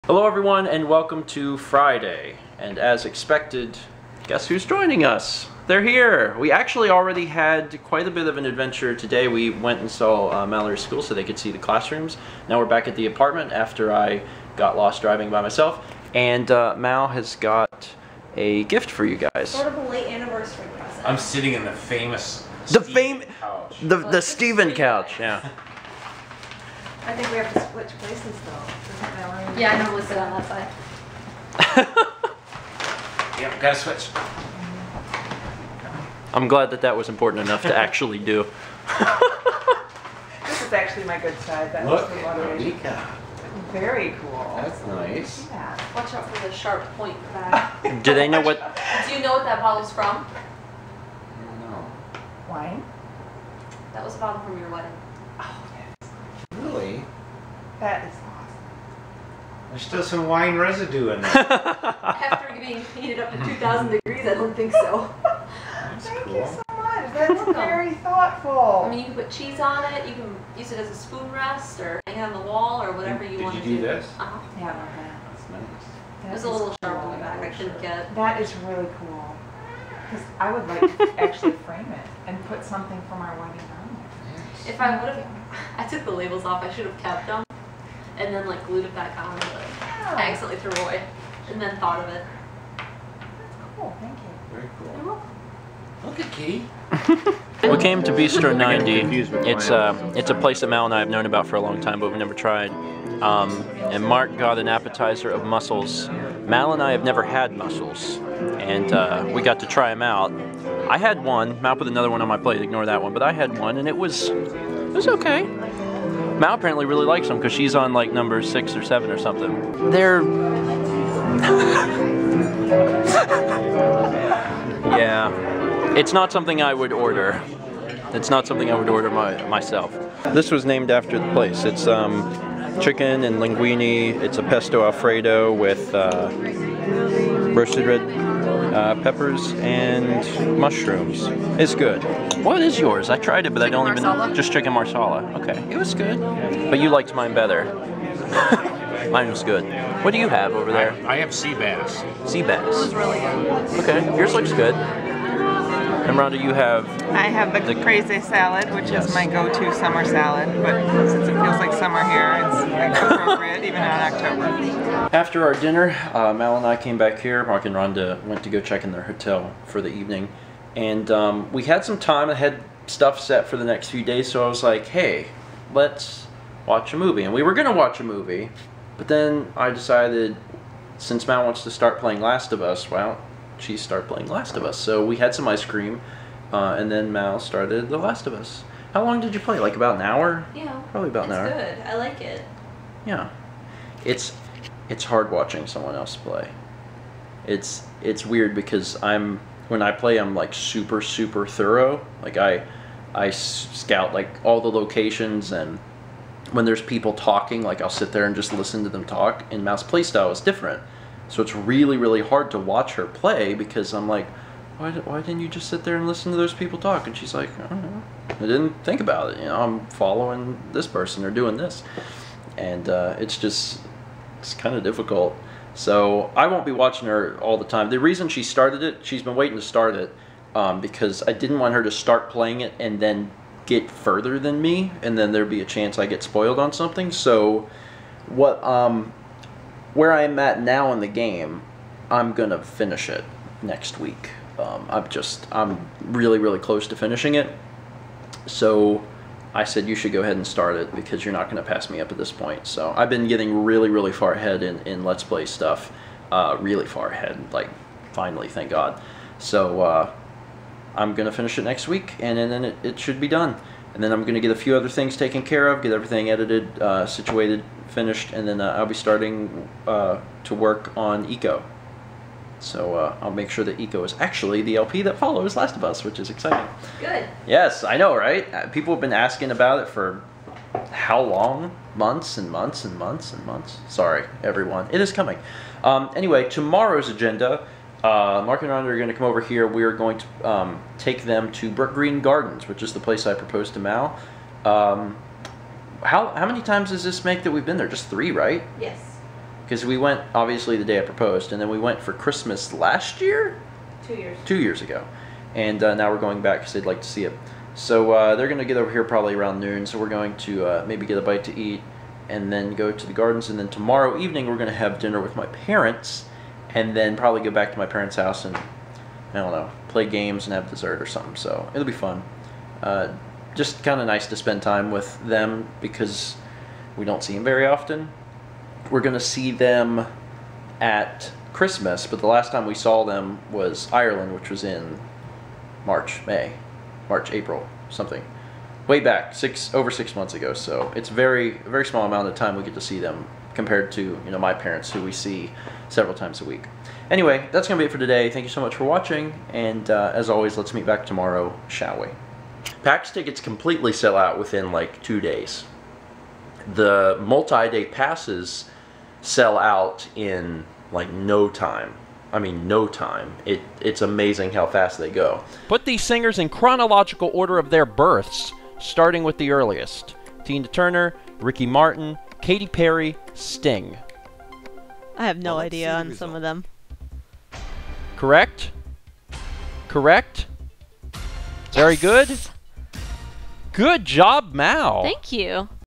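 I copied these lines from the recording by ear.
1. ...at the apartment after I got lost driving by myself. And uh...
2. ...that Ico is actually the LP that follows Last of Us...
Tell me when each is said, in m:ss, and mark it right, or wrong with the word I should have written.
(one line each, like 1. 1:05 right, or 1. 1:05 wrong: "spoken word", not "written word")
1. 0:12 right
2. 4:33 right.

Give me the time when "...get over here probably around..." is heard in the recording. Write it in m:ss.
5:08.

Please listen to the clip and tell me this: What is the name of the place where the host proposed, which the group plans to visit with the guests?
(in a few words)
Brookgreen Gardens.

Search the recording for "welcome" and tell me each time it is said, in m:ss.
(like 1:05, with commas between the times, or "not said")
0:00, 1:35.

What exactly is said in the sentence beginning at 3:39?
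You know, I'm following this person or doing this.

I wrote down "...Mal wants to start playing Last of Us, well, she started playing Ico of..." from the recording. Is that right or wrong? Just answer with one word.
wrong.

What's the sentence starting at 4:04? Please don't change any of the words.
Um, I'm just I'm really really close to finishing it.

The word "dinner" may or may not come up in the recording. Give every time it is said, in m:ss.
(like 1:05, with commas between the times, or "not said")
2:45, 5:14.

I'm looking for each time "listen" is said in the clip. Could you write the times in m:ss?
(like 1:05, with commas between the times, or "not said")
3:28, 3:36.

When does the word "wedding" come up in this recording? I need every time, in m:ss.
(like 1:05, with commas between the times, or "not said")
0:54, 1:23.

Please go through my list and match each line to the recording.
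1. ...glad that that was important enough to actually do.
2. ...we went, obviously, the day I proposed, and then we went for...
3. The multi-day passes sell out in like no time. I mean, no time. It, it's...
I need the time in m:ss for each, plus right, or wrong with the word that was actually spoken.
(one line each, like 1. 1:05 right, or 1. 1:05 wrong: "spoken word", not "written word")
1. 0:36 right
2. 4:59 right
3. 5:56 right.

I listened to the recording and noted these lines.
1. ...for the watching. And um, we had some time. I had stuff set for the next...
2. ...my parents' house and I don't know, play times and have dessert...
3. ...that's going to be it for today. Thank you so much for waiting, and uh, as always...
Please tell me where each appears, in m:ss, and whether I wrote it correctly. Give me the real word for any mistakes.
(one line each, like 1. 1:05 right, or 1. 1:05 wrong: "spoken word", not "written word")
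1. 2:49 wrong: "evening", not "watching"
2. 5:17 wrong: "games", not "times"
3. 5:47 wrong: "watching", not "waiting".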